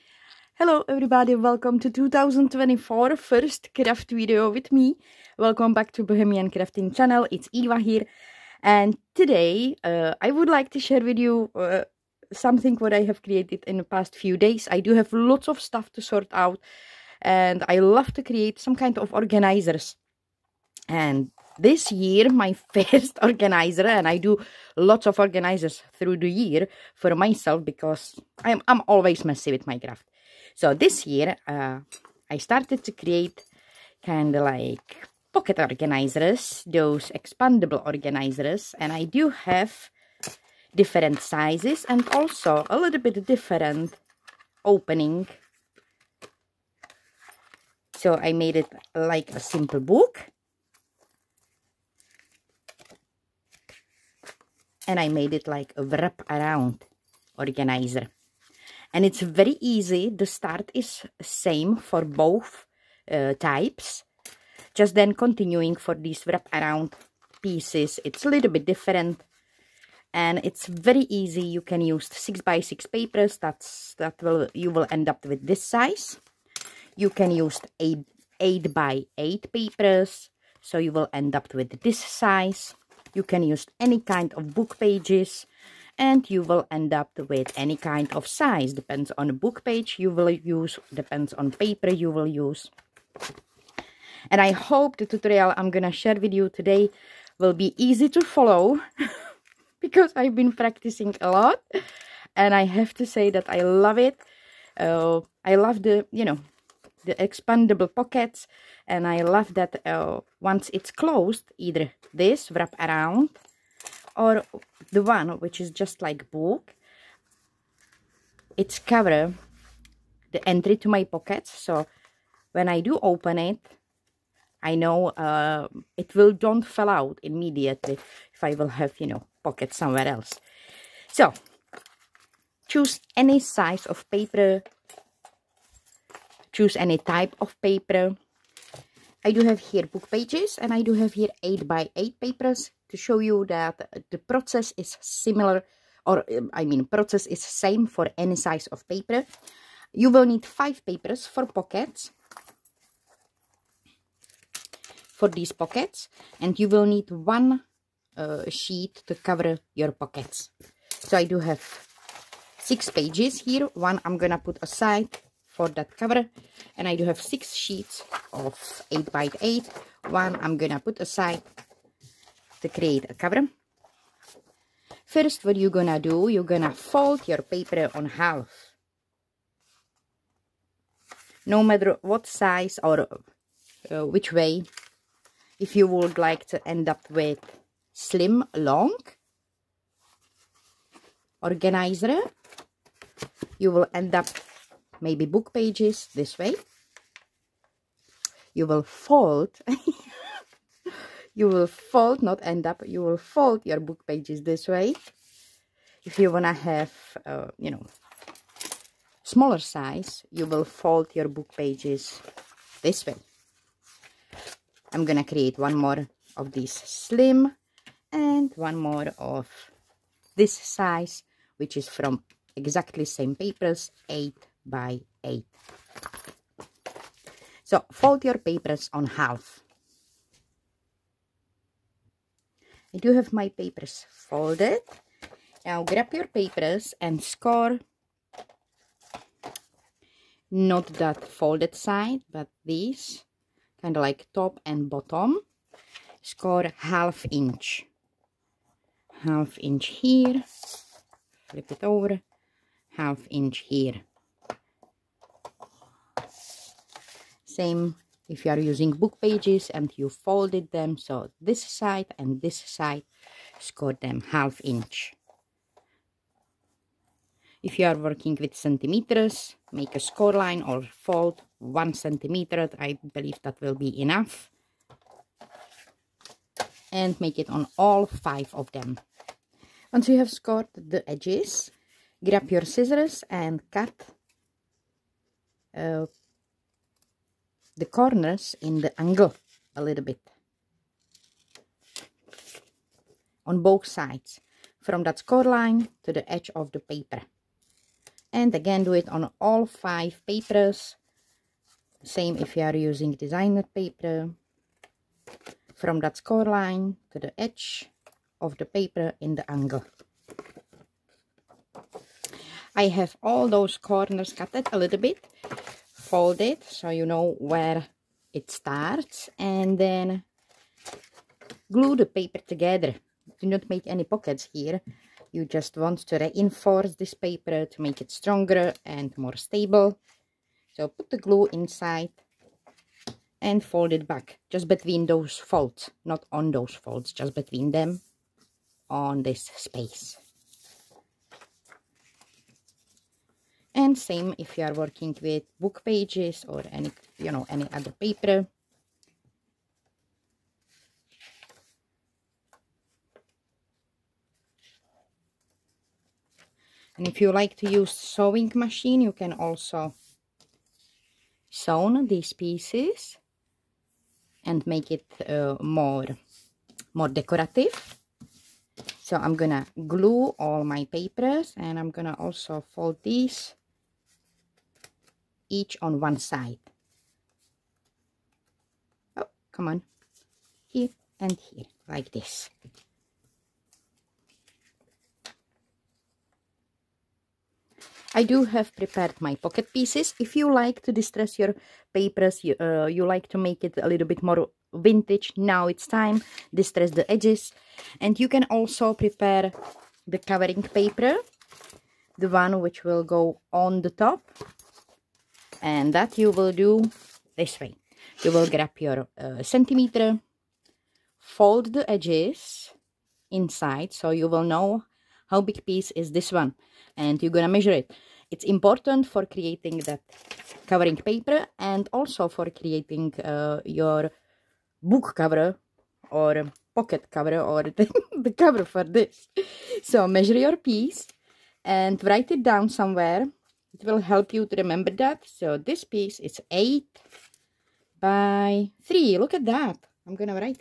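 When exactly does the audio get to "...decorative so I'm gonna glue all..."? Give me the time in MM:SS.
06:07.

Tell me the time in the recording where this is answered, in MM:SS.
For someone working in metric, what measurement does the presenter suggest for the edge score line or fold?
04:31.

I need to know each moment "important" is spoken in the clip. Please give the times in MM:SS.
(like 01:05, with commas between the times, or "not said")
06:58.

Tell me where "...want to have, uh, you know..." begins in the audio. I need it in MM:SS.
03:26.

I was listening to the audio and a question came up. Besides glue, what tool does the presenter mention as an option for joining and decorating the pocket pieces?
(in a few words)
Sewing machine.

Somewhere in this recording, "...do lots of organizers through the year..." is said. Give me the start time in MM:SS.
00:24.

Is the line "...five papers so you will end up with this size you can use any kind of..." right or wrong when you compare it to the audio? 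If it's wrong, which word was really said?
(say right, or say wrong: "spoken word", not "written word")
wrong: "eight", not "five".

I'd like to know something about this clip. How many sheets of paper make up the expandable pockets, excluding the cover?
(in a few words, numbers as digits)
5.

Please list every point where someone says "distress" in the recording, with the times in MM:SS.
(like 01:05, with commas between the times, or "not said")
06:30, 06:36.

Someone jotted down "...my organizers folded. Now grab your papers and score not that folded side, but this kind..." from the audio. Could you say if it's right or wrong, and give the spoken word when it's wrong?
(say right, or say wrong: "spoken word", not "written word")
wrong: "papers", not "organizers".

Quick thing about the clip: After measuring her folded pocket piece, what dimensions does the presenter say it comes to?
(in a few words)
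8 by 3.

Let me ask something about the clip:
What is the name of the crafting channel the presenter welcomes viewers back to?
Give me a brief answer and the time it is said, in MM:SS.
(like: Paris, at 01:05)
Bohemian Crafting, at 00:06.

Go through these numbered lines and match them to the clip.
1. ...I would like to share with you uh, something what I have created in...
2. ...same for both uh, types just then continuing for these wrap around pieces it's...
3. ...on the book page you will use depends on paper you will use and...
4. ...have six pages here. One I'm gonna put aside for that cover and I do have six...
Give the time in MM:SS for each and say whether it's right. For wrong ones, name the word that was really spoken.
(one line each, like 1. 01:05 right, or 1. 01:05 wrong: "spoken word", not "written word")
1. 00:10 right
2. 01:01 right
3. 01:29 right
4. 02:41 right.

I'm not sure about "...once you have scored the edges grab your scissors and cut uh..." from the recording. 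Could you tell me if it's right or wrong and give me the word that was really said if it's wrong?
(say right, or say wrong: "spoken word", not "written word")
right.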